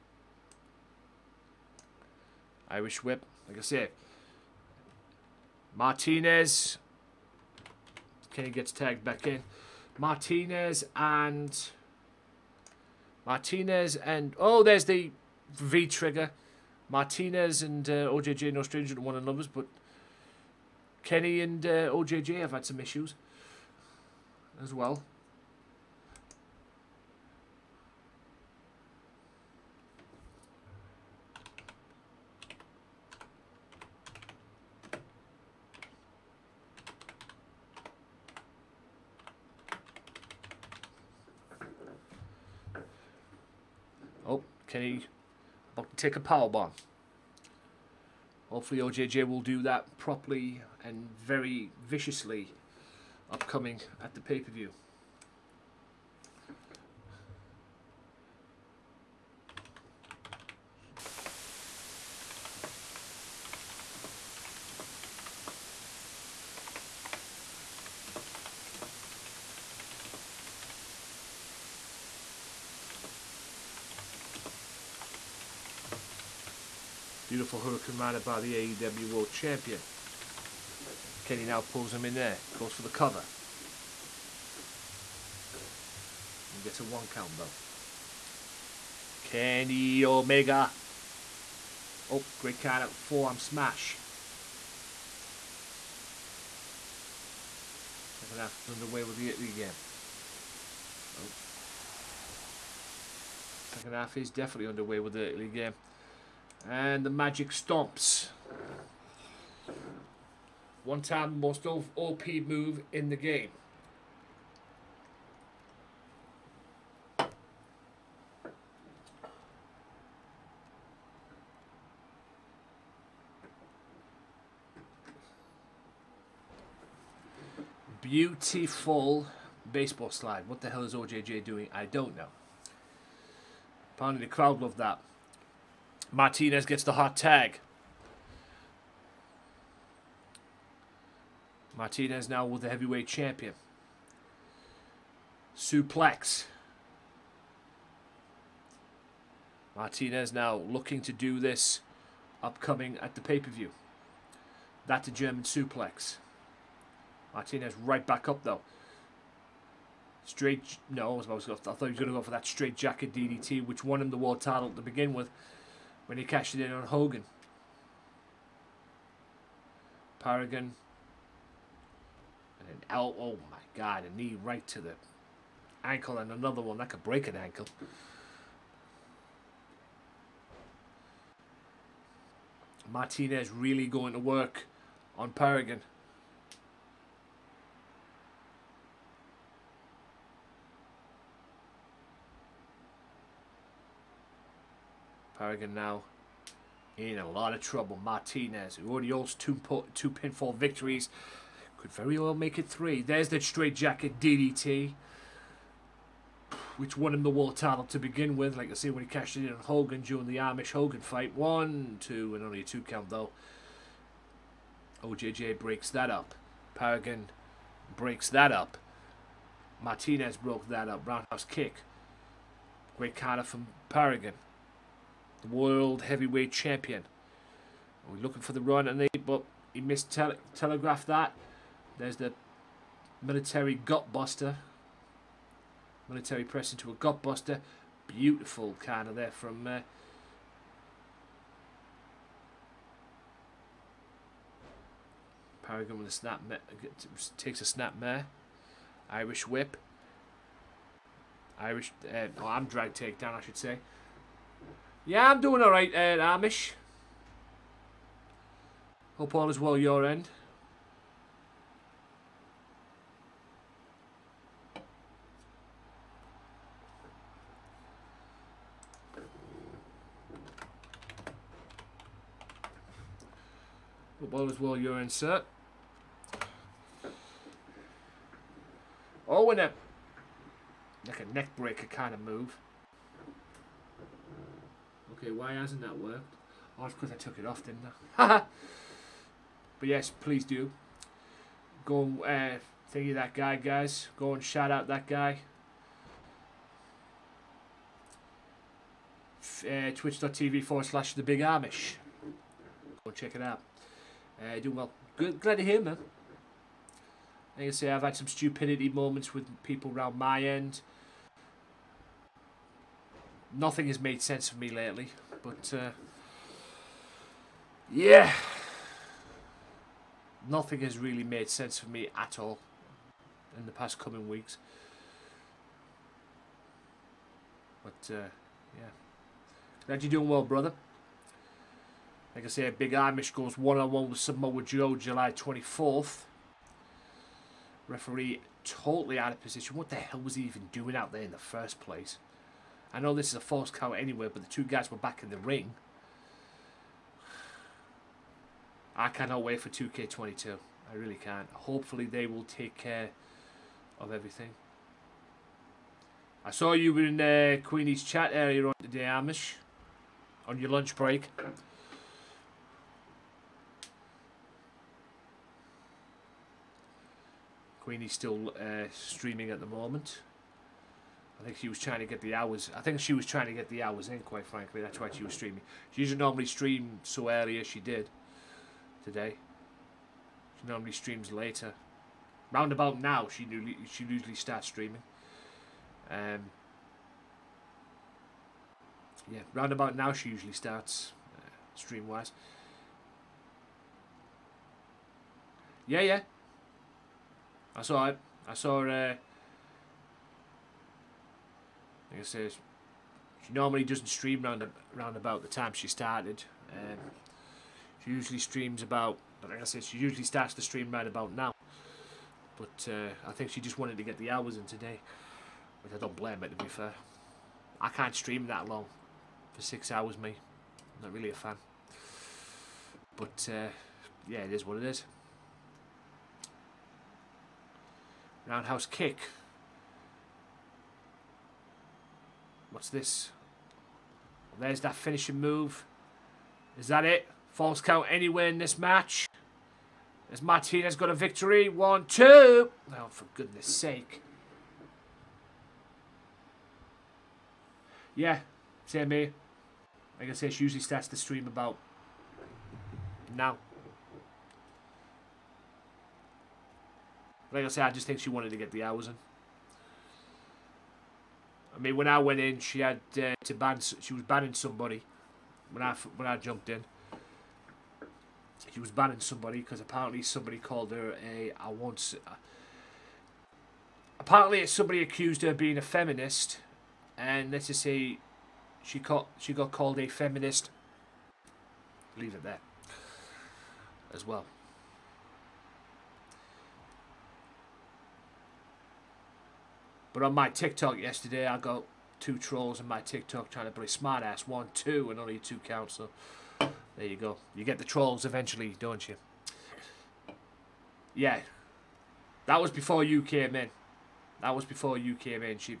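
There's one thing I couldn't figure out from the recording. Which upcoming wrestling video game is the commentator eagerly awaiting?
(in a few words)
2K22.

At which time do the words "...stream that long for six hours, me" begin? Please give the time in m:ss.
6:58.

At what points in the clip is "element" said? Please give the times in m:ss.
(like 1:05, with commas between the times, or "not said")
not said.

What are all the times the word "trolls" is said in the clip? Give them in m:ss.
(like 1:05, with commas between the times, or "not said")
8:12, 8:17.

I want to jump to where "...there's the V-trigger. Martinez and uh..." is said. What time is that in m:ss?
0:14.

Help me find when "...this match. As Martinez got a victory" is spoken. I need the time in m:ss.
7:18.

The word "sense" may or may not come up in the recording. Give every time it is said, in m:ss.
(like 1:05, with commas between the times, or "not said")
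5:14, 5:21.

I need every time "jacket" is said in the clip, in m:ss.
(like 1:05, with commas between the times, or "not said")
2:42, 3:23.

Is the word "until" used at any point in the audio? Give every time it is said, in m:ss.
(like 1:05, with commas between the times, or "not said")
not said.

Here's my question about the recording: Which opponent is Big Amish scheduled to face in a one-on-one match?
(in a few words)
Samoa Joe.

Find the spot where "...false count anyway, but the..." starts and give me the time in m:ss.
5:43.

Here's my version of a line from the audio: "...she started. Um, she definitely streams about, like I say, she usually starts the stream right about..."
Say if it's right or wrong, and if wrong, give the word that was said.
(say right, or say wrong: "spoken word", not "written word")
wrong: "usually", not "definitely".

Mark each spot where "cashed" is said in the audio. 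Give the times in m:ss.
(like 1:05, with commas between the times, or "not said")
2:46, 3:29.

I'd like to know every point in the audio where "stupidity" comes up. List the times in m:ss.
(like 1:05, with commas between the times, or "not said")
5:08.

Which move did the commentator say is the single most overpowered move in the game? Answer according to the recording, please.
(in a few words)
Magic stomps.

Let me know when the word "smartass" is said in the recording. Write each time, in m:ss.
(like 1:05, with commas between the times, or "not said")
8:13.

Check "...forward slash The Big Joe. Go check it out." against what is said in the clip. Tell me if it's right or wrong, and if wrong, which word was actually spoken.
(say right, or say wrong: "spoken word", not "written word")
wrong: "Amish", not "Joe".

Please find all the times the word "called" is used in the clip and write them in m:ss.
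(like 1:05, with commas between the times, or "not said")
7:50, 7:59.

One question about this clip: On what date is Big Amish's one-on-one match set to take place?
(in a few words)
July 24th.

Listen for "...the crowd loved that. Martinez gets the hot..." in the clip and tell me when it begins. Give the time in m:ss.
2:14.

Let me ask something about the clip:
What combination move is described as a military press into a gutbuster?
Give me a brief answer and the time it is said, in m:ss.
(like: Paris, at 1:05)
Military gutbuster, at 3:53.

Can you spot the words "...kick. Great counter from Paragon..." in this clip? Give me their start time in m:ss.
3:41.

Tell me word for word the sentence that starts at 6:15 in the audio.
She usually normally stream so early as she did today.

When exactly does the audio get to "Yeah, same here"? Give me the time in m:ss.
7:28.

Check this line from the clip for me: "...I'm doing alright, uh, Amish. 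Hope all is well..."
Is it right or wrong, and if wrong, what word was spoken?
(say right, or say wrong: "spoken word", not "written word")
right.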